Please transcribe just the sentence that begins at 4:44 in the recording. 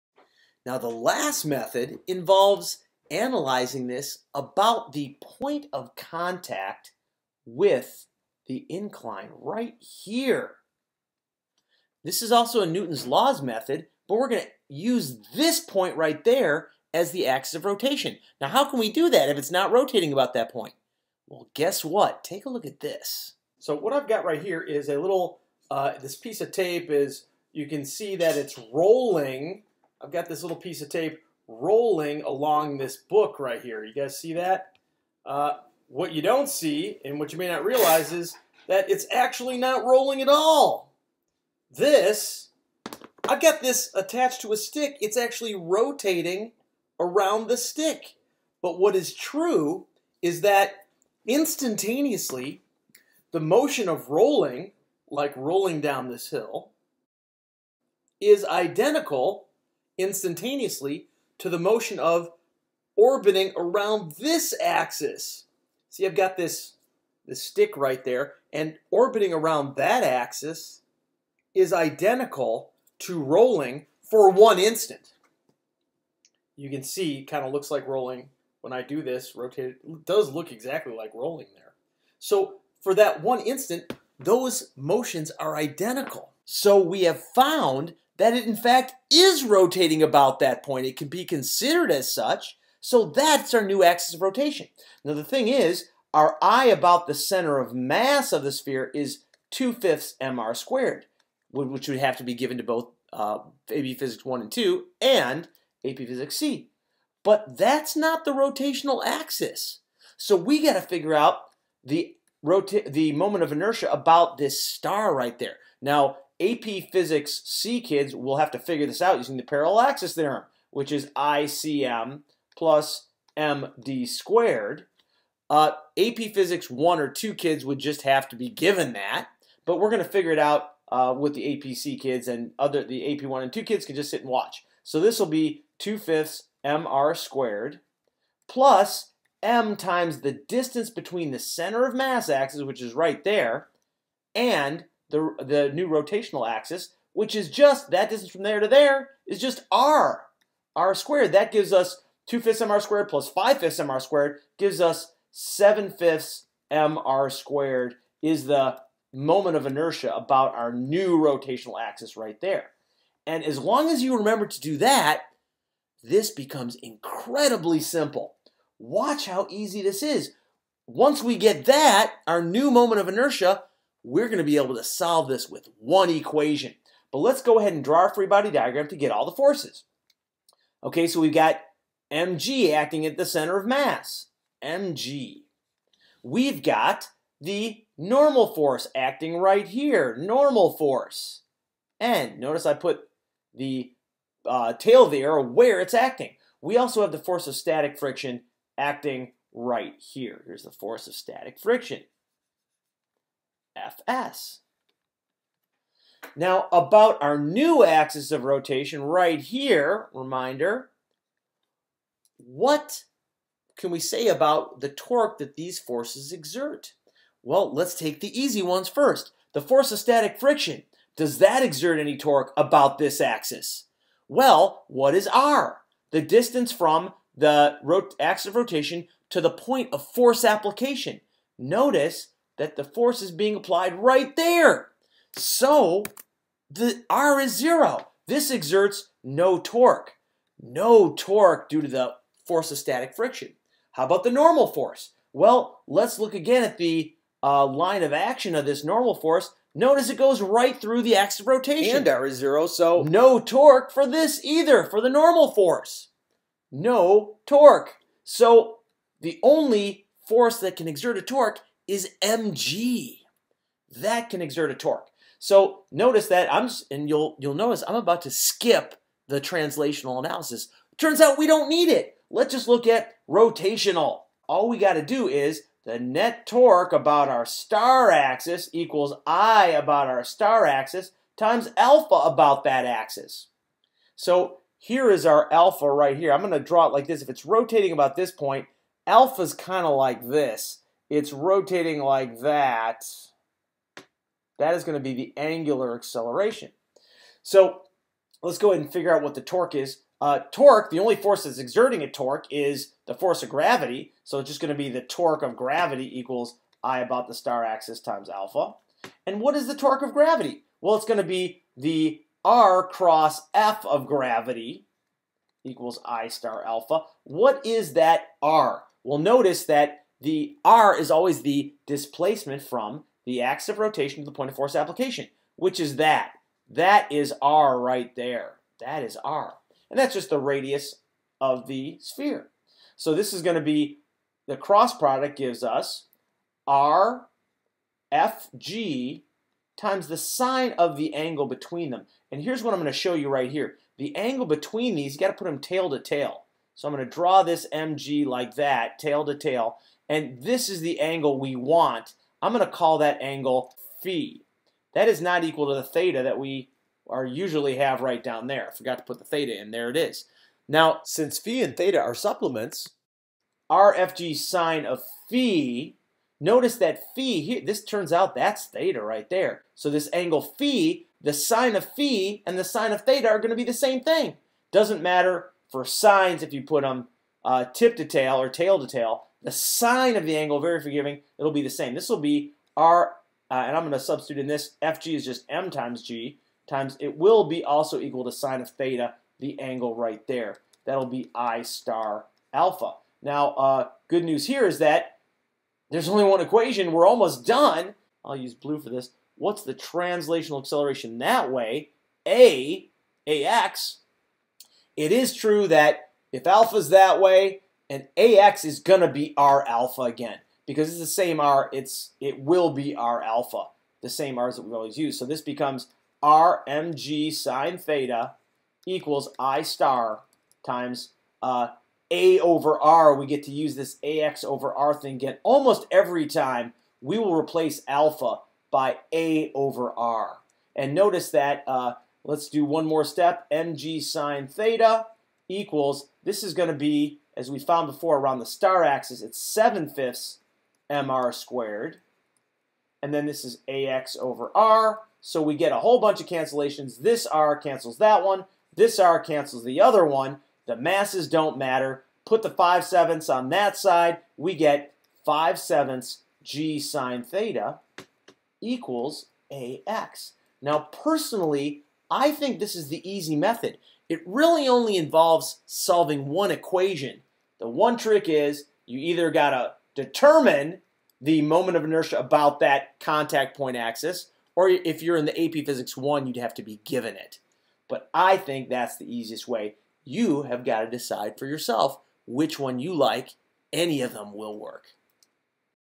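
So here is our alpha right here.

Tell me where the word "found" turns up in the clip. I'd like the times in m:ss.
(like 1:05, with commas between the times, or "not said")
1:27, 7:17.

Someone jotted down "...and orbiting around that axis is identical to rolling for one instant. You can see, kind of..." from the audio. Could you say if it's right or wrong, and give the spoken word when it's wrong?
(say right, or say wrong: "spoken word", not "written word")
right.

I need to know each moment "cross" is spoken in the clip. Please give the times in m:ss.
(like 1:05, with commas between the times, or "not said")
5:12, 5:34.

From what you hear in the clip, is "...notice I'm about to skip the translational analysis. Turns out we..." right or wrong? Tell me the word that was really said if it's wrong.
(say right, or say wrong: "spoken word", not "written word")
right.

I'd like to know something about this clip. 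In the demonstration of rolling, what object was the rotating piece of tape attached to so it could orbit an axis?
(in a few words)
a stick.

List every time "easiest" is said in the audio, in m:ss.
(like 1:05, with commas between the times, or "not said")
7:59.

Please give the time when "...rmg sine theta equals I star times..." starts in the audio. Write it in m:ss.
6:56.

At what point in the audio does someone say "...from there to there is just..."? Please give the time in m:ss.
2:28.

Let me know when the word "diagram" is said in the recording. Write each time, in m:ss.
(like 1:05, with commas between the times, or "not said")
2:58.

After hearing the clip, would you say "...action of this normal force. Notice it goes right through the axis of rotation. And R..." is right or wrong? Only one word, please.
right.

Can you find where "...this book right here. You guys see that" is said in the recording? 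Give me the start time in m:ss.
0:32.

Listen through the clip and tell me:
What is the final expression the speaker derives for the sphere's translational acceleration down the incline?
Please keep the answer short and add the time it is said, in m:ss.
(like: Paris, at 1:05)
5/7 g sin theta, at 7:35.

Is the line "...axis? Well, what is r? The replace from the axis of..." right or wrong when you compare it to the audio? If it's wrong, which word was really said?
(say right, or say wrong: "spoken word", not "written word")
wrong: "distance", not "replace".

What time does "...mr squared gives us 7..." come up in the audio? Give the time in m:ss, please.
2:33.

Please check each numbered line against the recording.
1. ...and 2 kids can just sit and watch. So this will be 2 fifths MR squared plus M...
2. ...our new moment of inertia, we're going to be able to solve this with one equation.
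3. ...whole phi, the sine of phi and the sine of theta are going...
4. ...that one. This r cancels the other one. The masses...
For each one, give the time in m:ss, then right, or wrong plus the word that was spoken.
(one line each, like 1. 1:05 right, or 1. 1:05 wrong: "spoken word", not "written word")
1. 2:13 right
2. 2:52 right
3. 6:10 wrong: "angle", not "whole"
4. 7:27 right.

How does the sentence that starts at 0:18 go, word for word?
Now how can we do that if it's not rotating about that point?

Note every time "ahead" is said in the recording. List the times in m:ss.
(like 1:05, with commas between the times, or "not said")
2:57, 4:58.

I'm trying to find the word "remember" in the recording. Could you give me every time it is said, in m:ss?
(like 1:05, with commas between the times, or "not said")
2:44.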